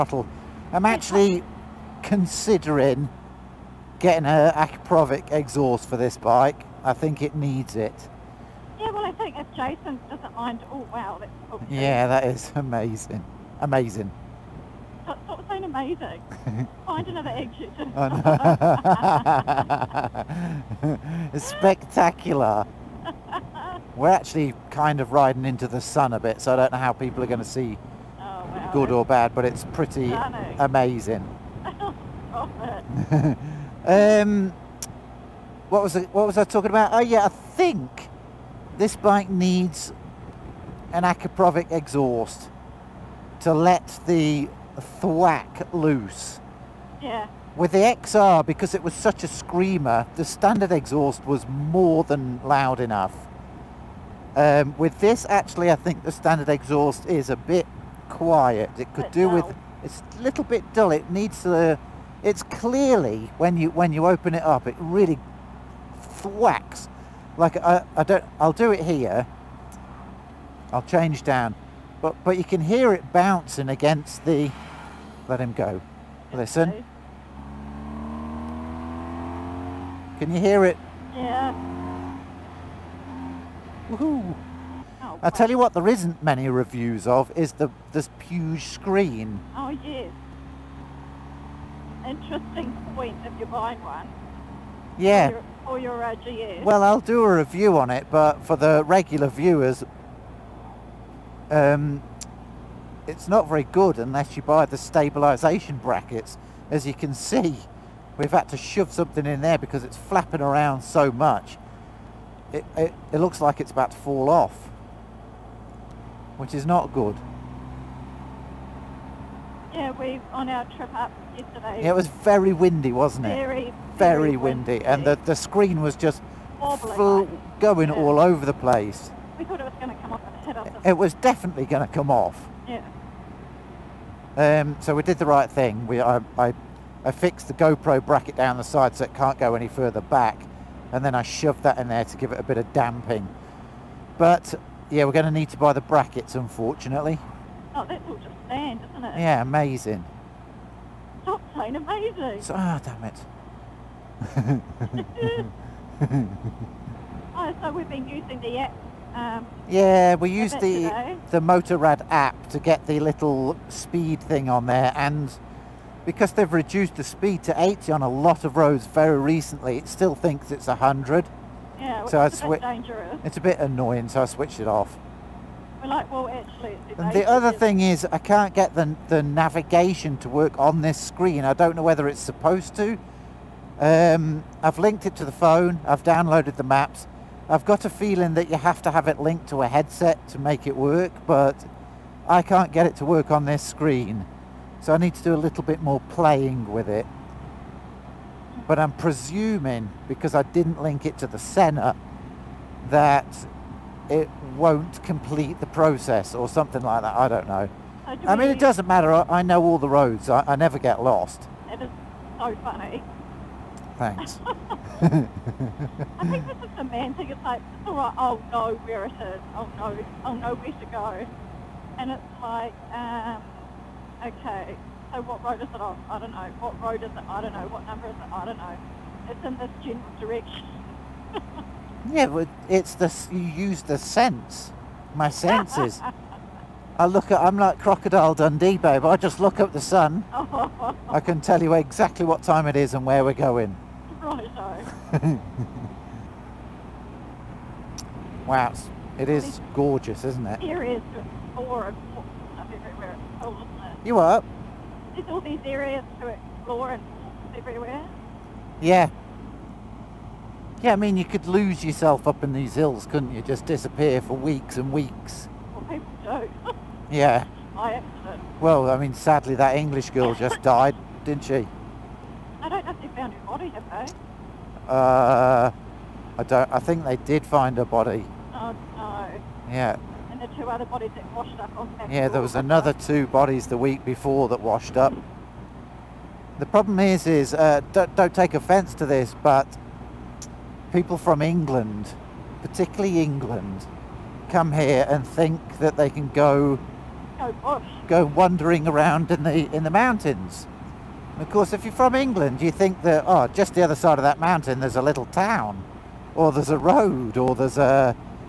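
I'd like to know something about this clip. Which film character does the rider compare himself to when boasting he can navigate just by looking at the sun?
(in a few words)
Crocodile Dundee.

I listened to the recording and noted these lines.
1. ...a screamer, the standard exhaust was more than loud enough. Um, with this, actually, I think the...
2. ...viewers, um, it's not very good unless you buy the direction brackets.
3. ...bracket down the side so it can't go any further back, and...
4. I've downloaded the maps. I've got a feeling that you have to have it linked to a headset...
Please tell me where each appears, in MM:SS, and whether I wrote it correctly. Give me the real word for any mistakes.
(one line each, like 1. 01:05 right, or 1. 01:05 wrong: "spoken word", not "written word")
1. 00:49 right
2. 01:39 wrong: "stabilisation", not "direction"
3. 02:18 right
4. 03:05 right.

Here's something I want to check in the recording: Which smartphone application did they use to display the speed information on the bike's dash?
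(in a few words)
Motorrad app.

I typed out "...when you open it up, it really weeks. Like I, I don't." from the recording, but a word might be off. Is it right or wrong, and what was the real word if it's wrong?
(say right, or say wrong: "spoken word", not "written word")
wrong: "thwacks", not "weeks".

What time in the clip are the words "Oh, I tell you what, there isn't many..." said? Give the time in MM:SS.
01:25.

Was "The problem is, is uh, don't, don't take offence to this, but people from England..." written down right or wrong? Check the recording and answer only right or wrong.
right.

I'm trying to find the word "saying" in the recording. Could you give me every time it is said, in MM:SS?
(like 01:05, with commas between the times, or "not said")
00:15, 02:31.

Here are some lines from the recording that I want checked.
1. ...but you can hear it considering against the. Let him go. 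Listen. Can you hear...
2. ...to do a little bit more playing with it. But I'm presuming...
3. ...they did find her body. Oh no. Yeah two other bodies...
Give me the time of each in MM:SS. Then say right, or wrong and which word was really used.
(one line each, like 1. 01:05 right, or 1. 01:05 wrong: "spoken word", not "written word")
1. 01:12 wrong: "bouncing", not "considering"
2. 03:15 right
3. 04:37 right.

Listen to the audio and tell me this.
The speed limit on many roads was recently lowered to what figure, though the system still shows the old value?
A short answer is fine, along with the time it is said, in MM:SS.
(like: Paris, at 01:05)
80, at 02:47.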